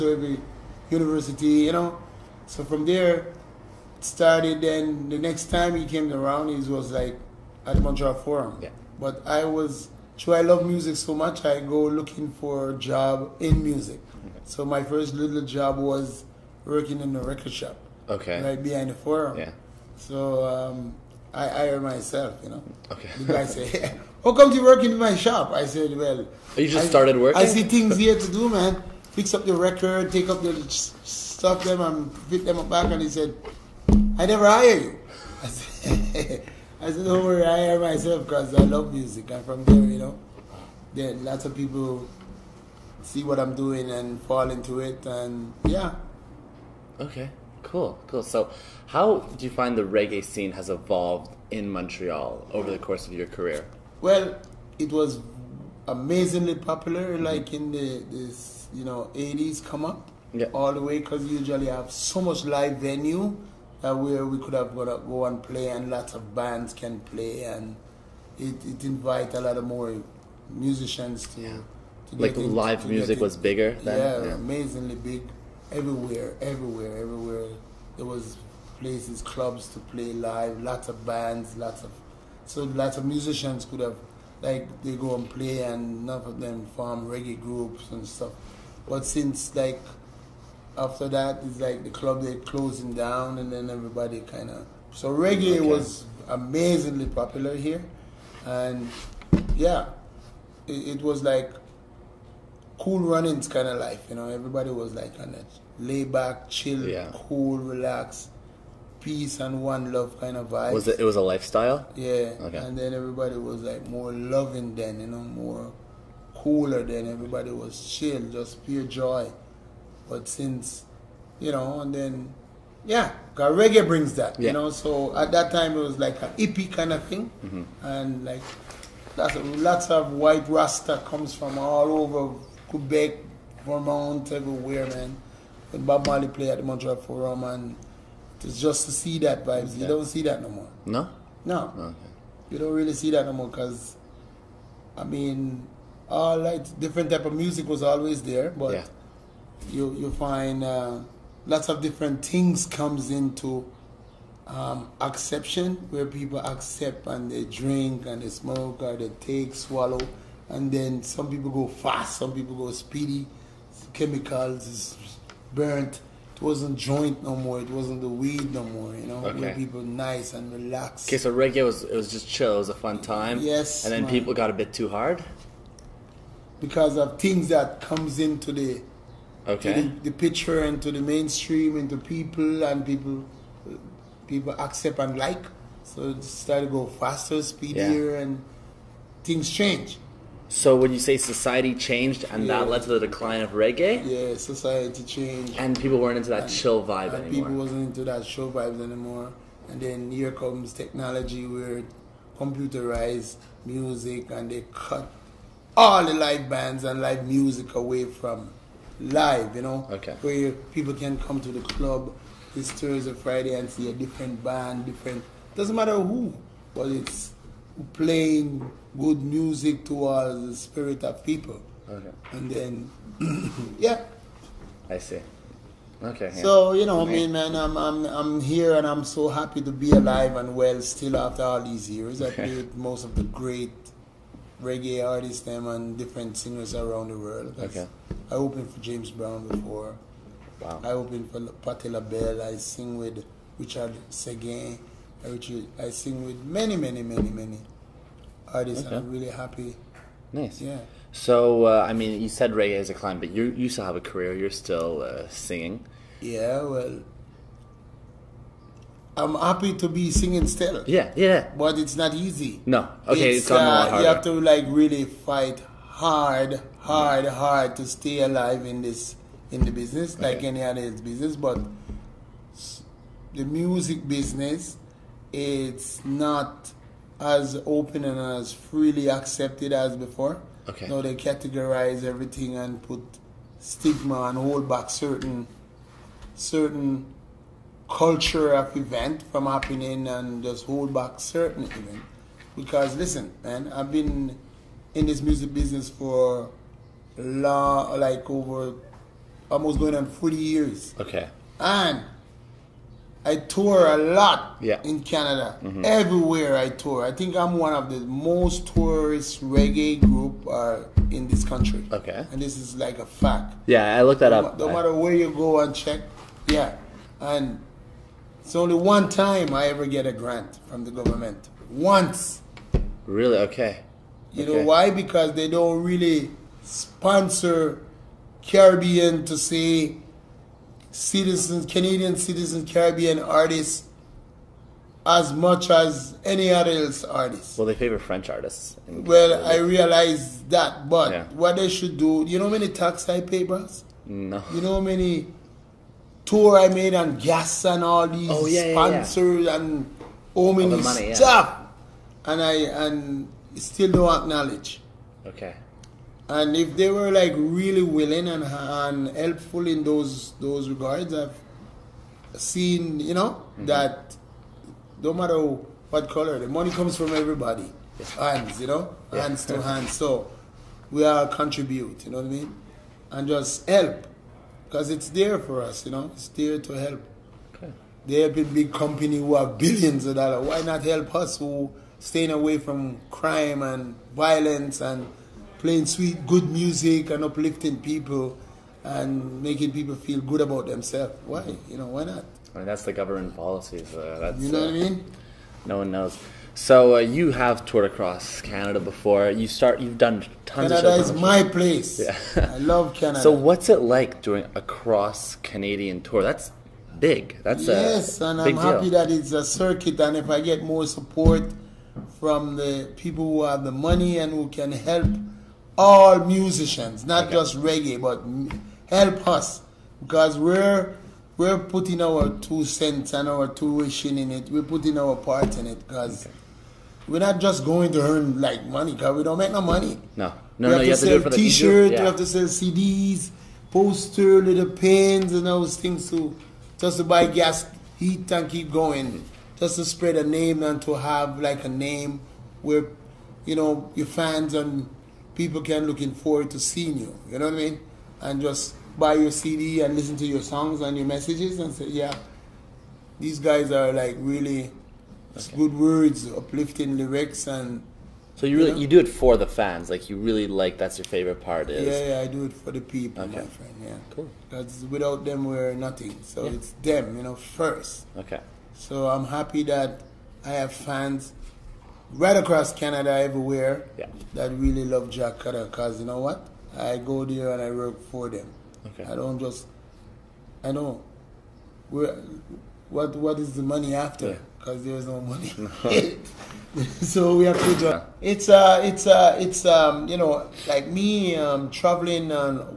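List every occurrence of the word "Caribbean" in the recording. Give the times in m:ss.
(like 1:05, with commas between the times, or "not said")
5:28, 5:32.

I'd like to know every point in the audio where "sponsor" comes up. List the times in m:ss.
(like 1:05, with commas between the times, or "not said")
5:26, 5:48.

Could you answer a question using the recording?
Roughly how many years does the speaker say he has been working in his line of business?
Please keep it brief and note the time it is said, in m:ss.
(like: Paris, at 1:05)
40 years, at 5:00.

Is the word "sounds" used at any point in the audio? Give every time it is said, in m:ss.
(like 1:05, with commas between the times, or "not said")
not said.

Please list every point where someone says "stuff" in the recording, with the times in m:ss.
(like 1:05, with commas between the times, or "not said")
0:30, 1:28, 5:51.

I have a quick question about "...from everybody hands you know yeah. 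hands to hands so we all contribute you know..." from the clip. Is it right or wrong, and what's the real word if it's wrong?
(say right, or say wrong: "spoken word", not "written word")
right.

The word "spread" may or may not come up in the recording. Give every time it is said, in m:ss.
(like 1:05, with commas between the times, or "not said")
7:19.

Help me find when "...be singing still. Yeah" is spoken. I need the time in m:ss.
4:19.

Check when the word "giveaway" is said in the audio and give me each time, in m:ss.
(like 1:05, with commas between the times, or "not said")
not said.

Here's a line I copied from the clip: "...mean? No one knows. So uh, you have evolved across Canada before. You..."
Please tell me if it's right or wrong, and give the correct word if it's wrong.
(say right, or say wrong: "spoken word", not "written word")
wrong: "toured", not "evolved".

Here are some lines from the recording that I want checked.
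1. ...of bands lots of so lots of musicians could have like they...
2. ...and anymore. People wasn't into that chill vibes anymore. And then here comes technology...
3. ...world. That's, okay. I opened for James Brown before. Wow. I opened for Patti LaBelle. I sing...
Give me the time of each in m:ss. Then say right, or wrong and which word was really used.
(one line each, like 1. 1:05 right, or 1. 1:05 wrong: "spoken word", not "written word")
1. 1:20 right
2. 3:17 right
3. 3:57 right.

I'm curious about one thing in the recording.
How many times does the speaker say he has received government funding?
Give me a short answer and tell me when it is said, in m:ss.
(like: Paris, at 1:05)
Once, at 5:21.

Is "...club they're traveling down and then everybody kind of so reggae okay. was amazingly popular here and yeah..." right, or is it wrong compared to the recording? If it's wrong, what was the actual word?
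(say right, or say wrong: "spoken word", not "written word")
wrong: "closing", not "traveling".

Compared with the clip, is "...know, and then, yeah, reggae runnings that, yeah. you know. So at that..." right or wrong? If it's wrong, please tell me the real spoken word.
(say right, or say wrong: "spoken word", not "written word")
wrong: "brings", not "runnings".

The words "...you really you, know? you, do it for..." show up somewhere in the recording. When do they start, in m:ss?
7:38.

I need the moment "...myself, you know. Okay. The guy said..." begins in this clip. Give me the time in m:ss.
0:21.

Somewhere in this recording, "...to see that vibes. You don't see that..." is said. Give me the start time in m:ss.
2:18.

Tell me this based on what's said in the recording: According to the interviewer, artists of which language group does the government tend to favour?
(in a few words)
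French.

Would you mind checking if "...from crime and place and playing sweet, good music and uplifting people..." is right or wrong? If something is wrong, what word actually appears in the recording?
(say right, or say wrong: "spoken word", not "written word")
wrong: "violence", not "place".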